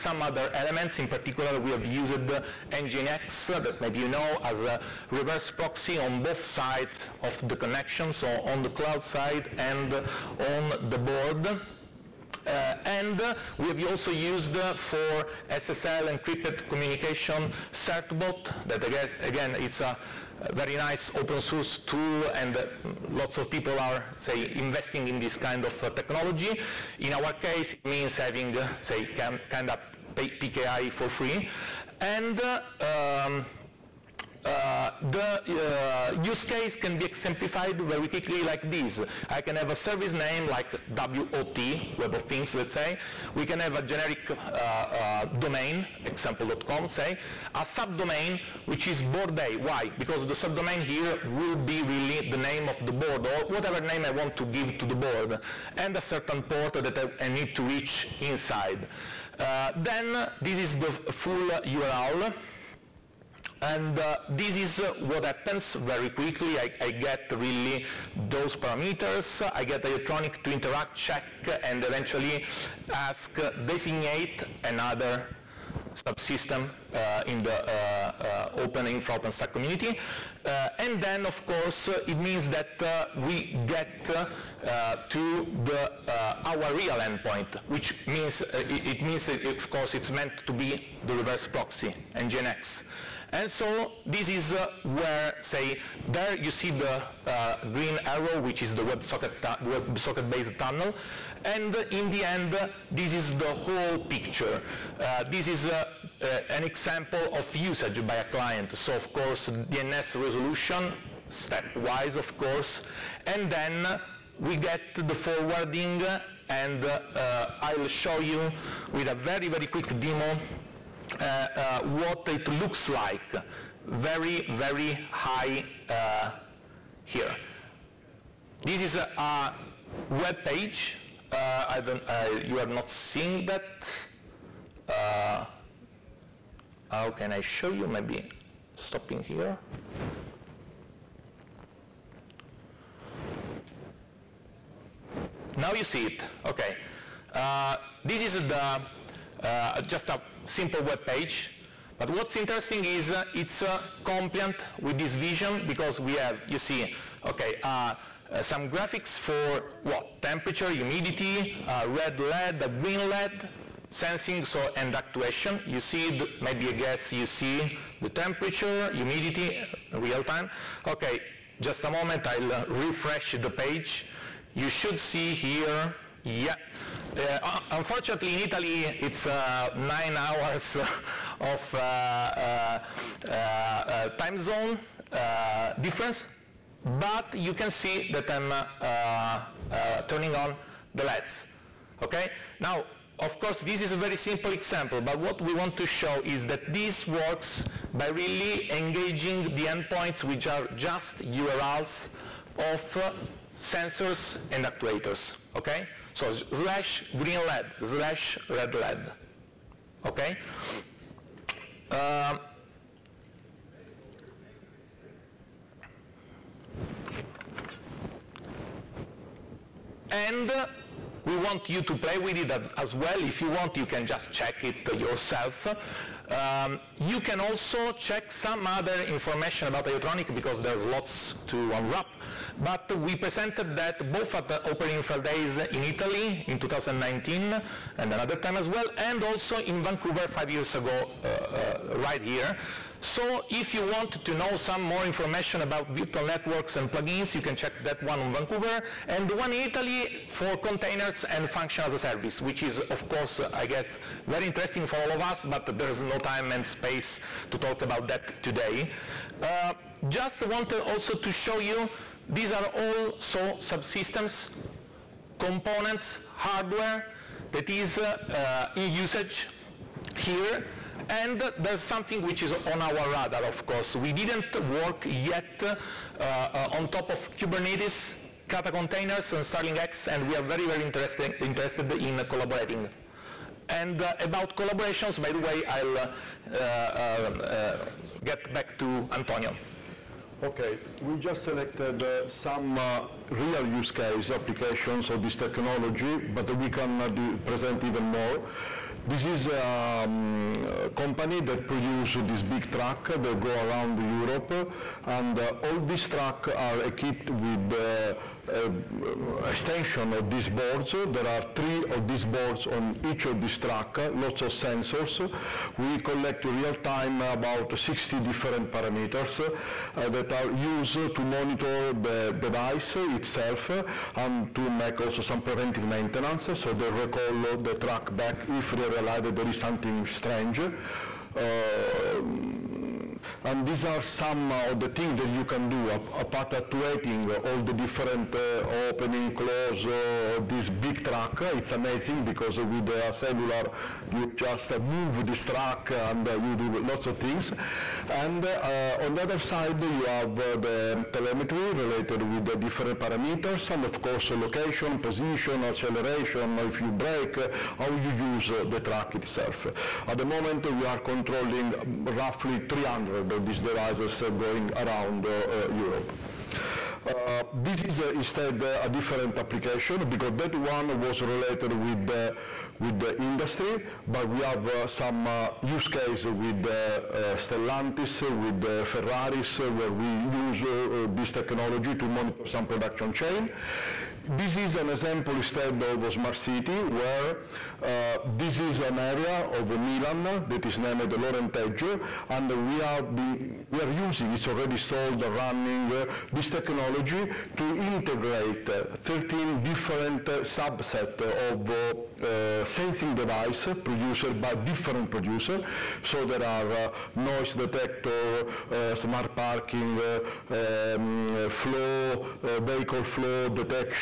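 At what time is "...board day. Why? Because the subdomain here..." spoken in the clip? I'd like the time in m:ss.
0:49.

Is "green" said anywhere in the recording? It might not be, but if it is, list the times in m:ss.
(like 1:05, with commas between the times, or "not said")
1:37, 2:42, 3:27.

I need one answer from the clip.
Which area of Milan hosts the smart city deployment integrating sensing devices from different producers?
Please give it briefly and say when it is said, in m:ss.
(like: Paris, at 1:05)
Lorenteggio, at 6:31.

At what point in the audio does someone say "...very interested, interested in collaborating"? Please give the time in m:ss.
4:40.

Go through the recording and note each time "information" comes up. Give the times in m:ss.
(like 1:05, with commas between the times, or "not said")
3:49, 4:05.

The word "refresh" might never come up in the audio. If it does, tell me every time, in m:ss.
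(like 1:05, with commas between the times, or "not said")
2:52.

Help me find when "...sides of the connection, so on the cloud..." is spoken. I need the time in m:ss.
0:06.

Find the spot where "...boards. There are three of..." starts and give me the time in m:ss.
5:10.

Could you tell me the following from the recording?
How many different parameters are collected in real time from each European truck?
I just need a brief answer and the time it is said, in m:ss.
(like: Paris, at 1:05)
60, at 5:17.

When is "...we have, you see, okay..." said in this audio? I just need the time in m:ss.
2:35.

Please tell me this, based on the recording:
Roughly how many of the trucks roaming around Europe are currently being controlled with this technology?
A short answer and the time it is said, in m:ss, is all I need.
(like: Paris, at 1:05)
300, at 6:02.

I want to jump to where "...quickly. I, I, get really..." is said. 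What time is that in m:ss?
1:06.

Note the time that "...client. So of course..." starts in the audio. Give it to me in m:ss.
1:48.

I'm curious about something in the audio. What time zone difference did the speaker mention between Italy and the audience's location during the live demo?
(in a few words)
9 hours.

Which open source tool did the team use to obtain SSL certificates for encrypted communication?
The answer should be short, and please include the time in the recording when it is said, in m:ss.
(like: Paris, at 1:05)
CertBot, at 0:17.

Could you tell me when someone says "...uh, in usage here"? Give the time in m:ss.
4:28.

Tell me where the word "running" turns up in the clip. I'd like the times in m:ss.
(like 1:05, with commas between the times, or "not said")
6:35.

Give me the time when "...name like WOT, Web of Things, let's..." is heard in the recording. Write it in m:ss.
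0:40.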